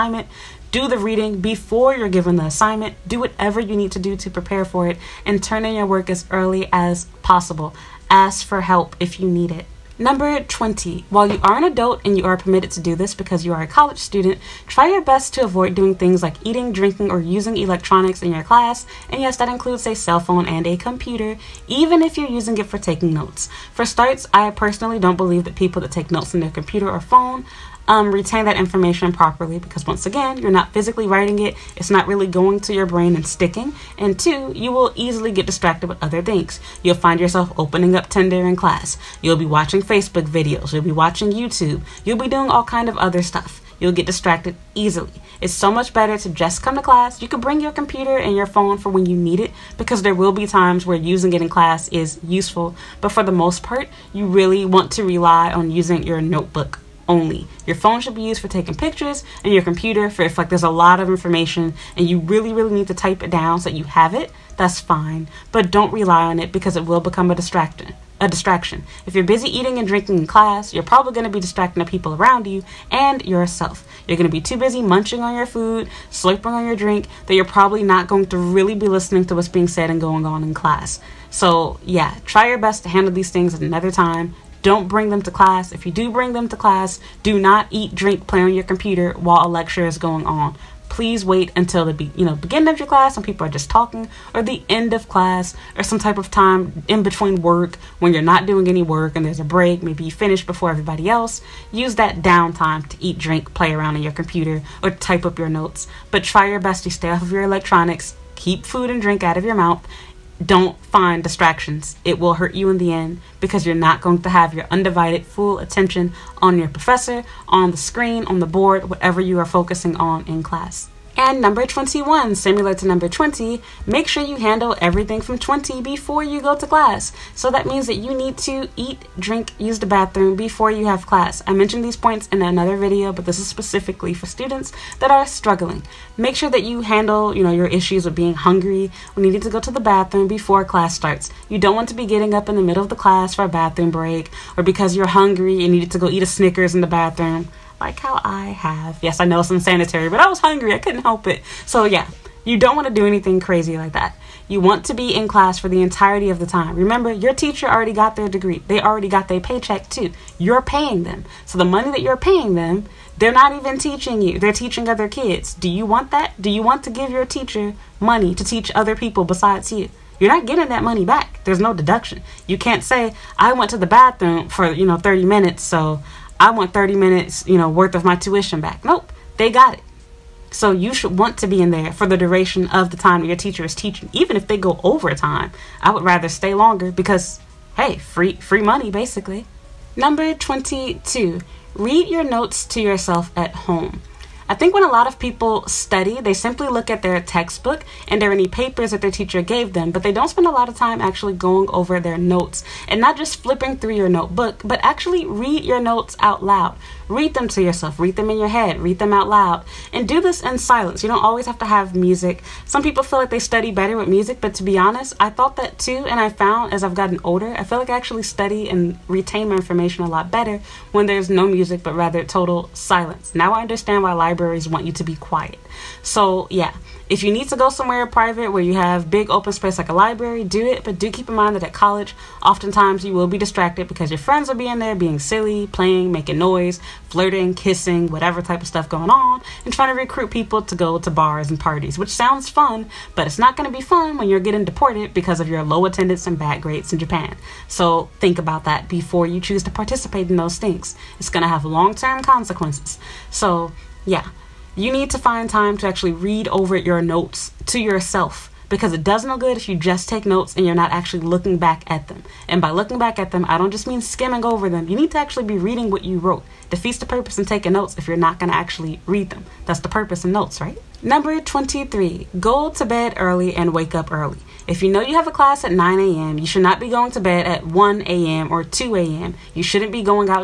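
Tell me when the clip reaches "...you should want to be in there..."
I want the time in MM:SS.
03:00.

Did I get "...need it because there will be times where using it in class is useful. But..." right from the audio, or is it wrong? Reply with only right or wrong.
right.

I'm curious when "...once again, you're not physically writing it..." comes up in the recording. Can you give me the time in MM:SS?
00:29.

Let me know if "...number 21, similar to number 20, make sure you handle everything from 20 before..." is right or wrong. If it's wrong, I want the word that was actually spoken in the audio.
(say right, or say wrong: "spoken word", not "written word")
right.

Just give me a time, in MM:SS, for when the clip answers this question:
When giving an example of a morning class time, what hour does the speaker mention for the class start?
04:35.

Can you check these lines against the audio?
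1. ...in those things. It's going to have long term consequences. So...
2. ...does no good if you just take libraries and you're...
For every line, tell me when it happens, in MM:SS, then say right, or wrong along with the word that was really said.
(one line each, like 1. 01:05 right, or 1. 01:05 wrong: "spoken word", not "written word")
1. 04:10 right
2. 04:19 wrong: "notes", not "libraries".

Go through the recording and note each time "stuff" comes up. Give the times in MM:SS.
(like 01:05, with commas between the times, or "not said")
00:43, 03:58.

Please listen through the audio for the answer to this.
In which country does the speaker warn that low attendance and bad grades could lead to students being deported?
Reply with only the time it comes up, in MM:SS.
04:06.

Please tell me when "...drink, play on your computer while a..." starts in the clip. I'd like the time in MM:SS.
01:27.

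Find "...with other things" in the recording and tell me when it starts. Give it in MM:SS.
00:35.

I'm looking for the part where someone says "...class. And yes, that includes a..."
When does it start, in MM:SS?
00:18.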